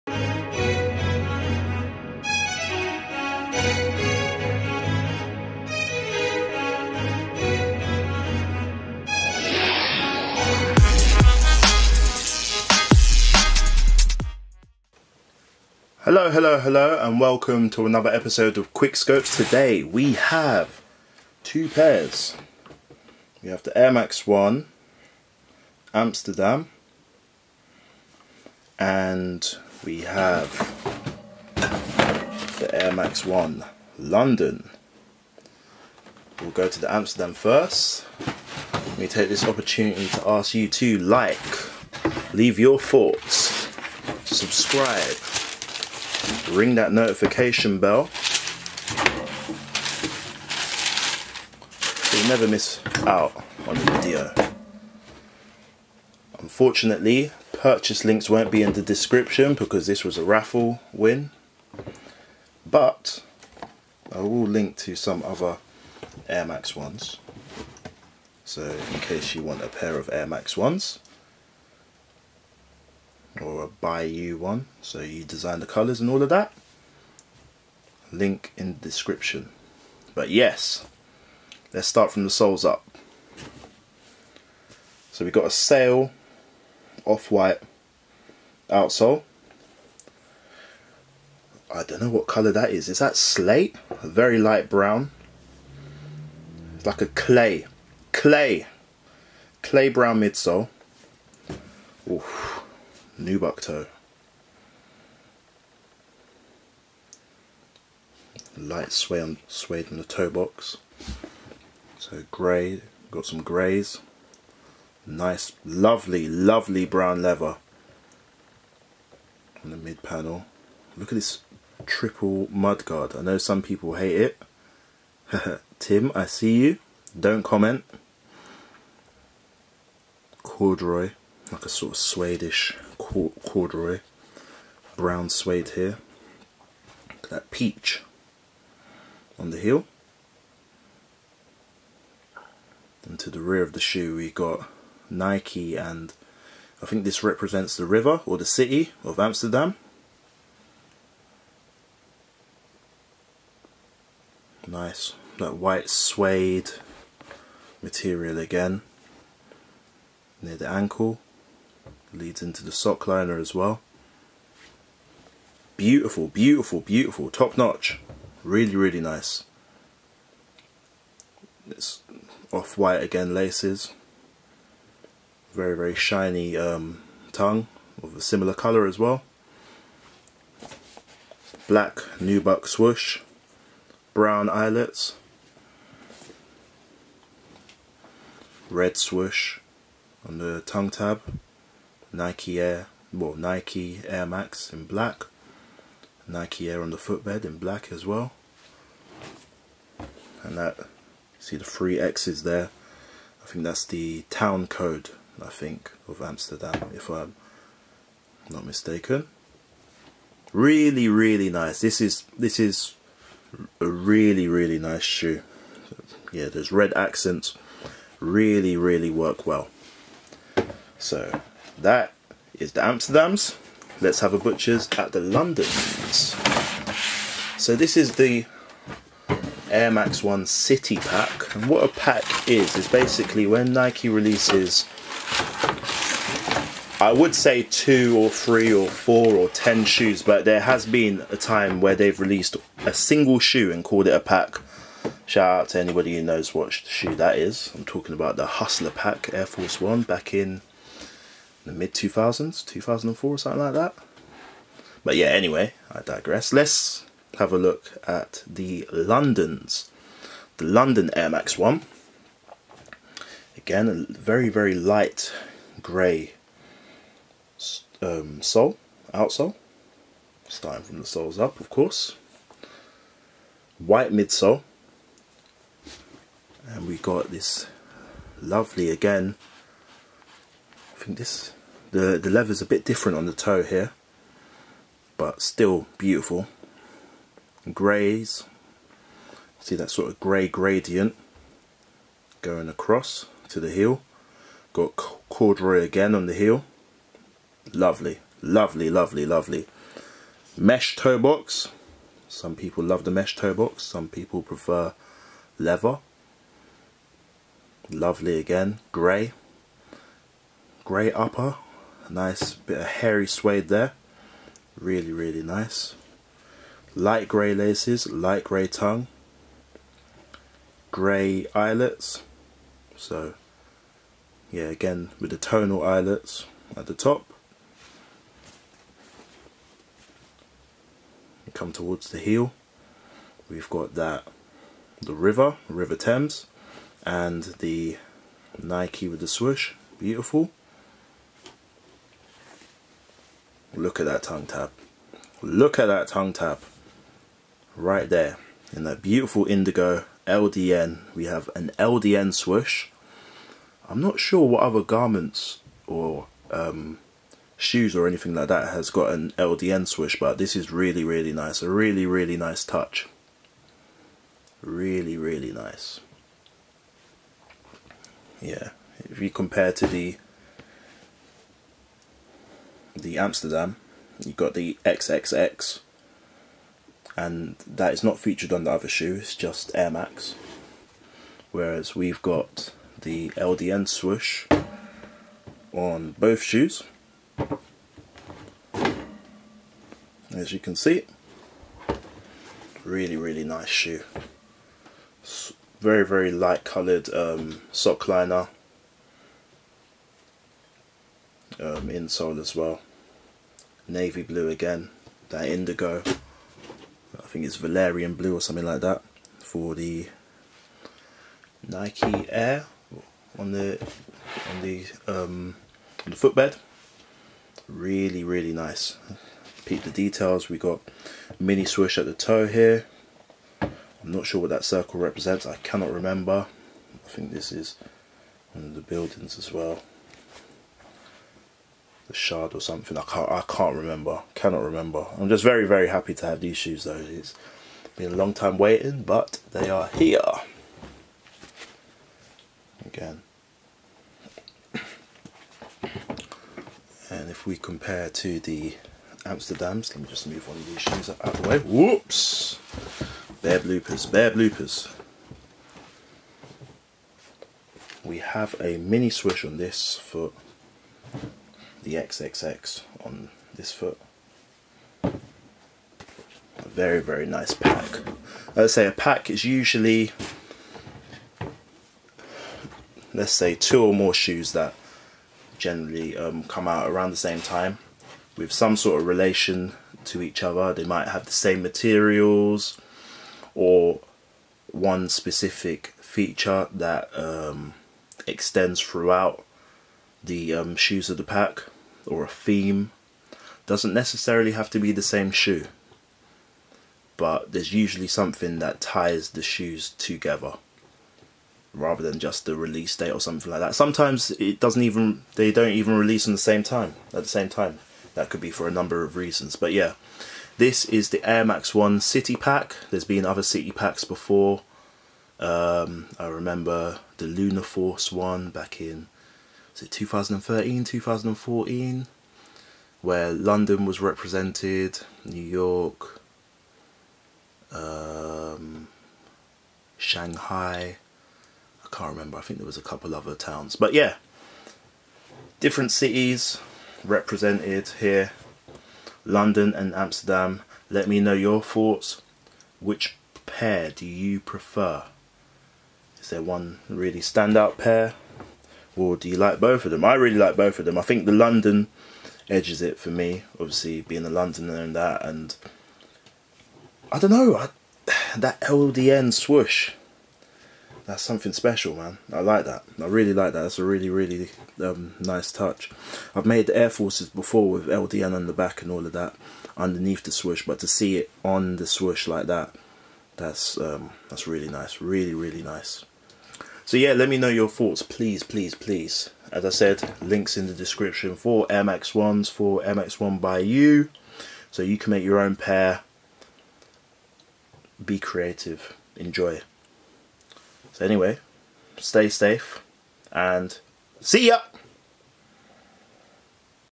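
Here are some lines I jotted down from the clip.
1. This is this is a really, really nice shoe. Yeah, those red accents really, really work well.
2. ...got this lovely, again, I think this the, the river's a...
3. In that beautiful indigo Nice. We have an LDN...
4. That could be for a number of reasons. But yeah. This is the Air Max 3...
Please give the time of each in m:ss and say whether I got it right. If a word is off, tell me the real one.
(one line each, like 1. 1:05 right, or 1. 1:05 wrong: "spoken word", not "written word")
1. 3:31 right
2. 4:36 wrong: "leather", not "river"
3. 5:48 wrong: "LDN", not "Nice"
4. 8:28 wrong: "1", not "3".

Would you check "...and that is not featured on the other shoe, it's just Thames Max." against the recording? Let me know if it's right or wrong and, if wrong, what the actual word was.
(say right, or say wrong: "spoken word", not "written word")
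wrong: "Air", not "Thames".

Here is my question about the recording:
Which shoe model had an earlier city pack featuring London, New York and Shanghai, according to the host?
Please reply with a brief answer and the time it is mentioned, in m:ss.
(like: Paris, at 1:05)
Lunar Force One, at 8:37.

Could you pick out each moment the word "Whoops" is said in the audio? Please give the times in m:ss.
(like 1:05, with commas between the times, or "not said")
7:31.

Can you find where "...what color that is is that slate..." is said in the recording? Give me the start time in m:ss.
1:32.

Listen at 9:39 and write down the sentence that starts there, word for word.
As I said, links in the description for Air Max 1s, for Air Max 1 by you.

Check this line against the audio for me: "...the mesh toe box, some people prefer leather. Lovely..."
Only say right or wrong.
right.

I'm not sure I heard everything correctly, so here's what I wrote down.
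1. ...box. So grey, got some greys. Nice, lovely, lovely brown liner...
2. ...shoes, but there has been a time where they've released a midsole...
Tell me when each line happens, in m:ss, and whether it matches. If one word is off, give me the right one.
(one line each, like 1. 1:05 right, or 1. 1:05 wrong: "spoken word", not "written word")
1. 1:50 wrong: "leather", not "liner"
2. 3:59 wrong: "single", not "midsole".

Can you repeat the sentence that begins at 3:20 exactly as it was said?
And that, see the three X's there.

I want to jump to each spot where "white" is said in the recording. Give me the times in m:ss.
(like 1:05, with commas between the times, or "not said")
1:27, 2:35, 2:52, 4:33.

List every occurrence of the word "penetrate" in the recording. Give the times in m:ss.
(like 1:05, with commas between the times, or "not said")
not said.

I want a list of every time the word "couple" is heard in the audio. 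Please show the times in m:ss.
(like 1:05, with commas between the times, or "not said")
8:52.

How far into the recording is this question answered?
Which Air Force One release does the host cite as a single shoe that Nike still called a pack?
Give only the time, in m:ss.
4:08.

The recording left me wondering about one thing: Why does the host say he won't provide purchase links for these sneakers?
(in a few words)
A raffle win.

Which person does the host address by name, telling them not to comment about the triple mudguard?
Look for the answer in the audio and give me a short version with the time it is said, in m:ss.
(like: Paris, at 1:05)
Tim, at 2:05.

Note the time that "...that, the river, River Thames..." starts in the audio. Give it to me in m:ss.
5:33.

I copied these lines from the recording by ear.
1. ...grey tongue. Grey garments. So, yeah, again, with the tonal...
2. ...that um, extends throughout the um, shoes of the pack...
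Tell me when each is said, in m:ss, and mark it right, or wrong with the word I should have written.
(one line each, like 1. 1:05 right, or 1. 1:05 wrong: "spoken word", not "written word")
1. 5:18 wrong: "eyelets", not "garments"
2. 8:06 right.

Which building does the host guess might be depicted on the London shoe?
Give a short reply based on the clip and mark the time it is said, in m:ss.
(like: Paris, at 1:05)
The Shard, at 7:12.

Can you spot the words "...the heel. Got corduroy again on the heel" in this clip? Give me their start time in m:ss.
4:53.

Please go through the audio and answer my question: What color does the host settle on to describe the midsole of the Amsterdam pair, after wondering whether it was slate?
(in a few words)
Clay brown.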